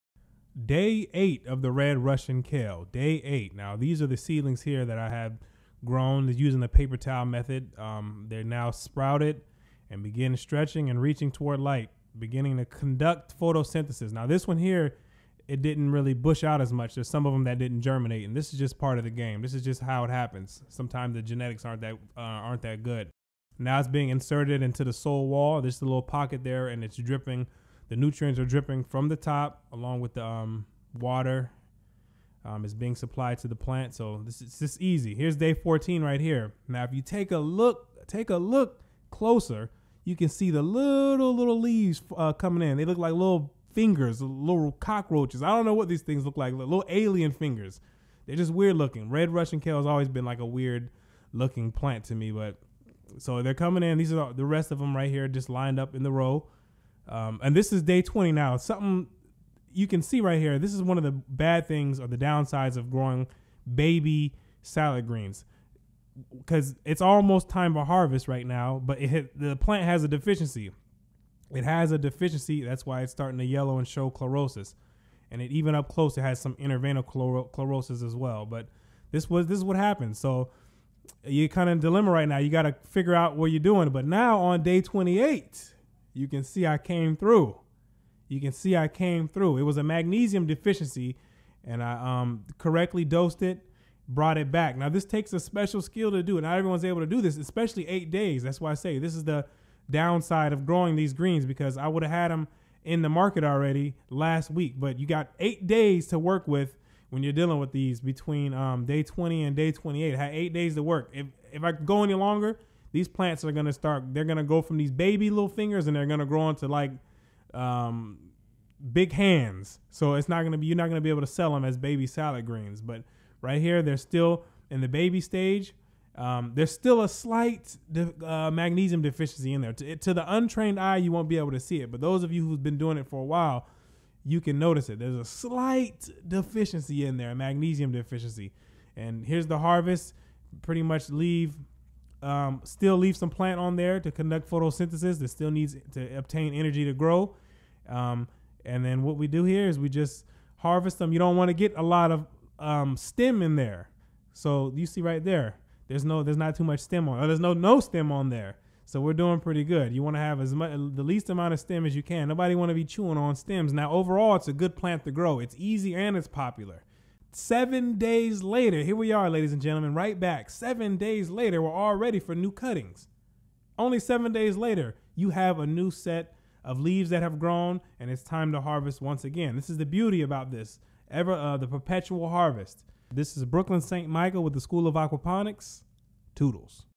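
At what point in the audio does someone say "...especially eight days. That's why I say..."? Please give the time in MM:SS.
01:37.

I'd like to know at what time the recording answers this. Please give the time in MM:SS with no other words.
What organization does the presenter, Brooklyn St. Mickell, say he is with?
03:04.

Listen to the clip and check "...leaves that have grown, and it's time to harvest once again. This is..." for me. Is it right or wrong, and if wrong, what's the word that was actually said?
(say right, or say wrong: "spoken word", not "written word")
right.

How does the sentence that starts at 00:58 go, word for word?
Something you can see right here.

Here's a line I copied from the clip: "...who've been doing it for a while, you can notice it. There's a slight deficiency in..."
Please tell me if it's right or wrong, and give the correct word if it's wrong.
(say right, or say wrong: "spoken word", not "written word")
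right.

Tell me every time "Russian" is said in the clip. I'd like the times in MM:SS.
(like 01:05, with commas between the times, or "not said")
00:01, 00:49.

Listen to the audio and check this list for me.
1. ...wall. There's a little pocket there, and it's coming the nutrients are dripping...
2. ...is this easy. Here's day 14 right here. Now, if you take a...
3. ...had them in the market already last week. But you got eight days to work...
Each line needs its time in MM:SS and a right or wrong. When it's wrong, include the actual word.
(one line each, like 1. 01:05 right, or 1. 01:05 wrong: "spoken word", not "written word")
1. 00:25 wrong: "dripping", not "coming"
2. 00:34 right
3. 01:42 right.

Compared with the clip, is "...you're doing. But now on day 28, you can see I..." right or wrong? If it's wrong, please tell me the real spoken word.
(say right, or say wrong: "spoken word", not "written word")
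right.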